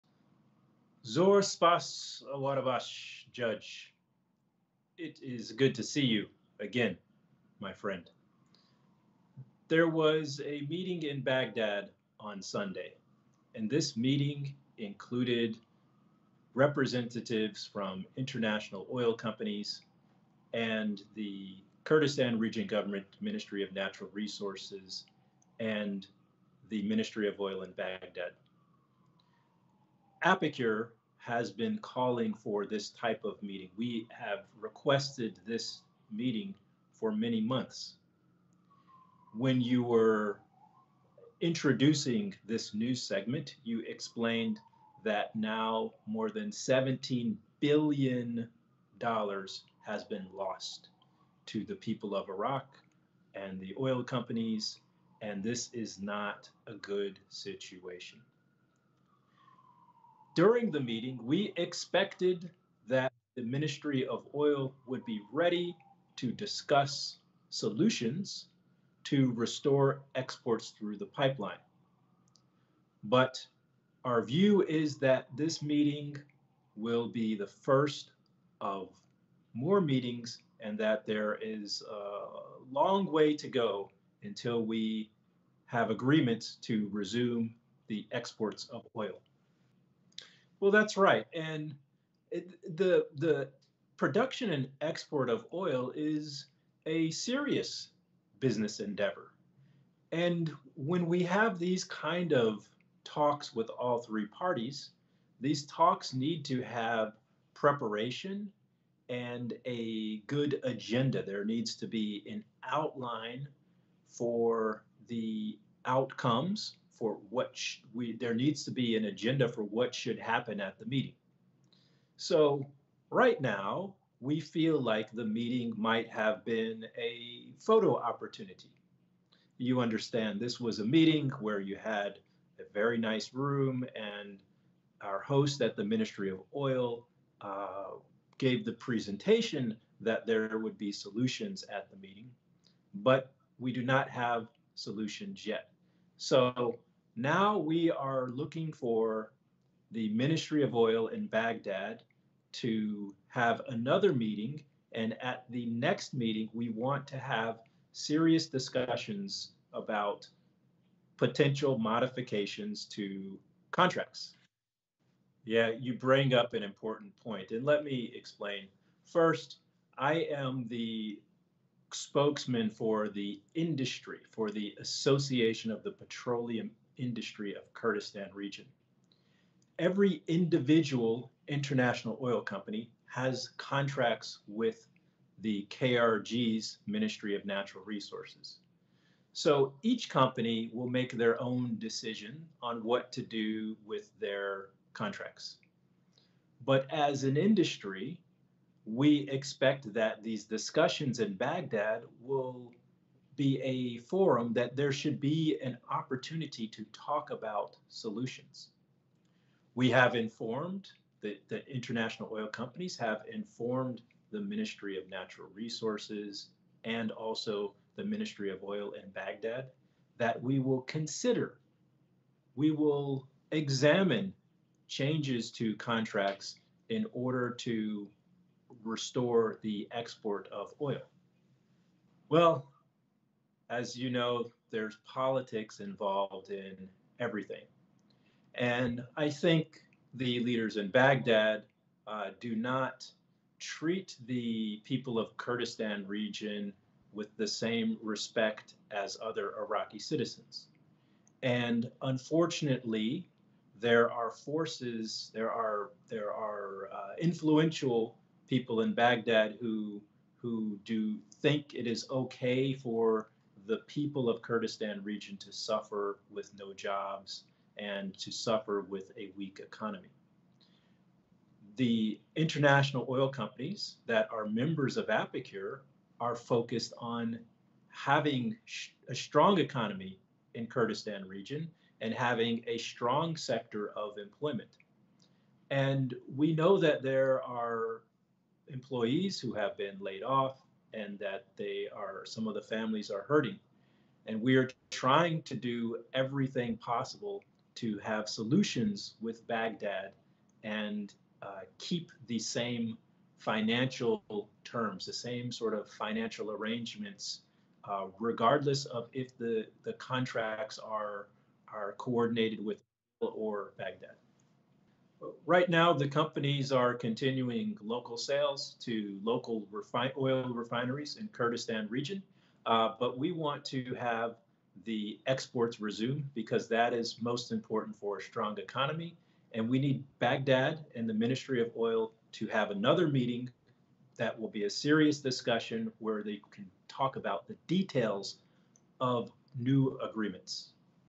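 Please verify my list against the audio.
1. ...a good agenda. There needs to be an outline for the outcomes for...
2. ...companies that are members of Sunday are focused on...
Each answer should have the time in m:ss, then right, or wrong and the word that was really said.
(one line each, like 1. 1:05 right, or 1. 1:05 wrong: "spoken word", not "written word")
1. 1:49 right
2. 4:33 wrong: "APIKUR", not "Sunday".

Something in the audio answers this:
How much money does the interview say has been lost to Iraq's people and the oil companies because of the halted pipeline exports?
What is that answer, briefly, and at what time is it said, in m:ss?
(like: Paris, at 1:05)
more than $17 billion, at 0:46.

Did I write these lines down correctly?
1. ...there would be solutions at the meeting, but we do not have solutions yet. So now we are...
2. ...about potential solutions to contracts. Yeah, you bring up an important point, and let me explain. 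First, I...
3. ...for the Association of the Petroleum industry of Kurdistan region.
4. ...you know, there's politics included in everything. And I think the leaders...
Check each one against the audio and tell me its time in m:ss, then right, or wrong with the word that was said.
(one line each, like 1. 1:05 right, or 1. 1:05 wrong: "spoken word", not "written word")
1. 2:20 right
2. 2:39 wrong: "modifications", not "solutions"
3. 2:54 right
4. 3:53 wrong: "involved", not "included".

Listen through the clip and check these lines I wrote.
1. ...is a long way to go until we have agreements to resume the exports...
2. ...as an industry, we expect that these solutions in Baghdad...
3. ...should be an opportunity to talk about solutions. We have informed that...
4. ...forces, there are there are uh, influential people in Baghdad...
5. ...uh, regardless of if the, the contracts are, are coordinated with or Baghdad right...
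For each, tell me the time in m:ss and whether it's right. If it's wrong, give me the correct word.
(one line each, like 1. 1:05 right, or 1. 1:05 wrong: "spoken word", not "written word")
1. 1:21 right
2. 3:16 wrong: "discussions", not "solutions"
3. 3:24 right
4. 4:14 right
5. 5:07 right.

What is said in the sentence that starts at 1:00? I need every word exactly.
During the meeting, we expected that the Ministry of Oil would be ready to discuss solutions to restore exports through the pipeline.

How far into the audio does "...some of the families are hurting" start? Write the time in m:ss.
4:52.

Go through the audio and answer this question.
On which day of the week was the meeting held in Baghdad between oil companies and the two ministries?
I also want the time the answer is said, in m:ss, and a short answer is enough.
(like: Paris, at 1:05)
Sunday, at 0:12.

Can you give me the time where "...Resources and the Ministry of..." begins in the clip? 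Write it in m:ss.
0:24.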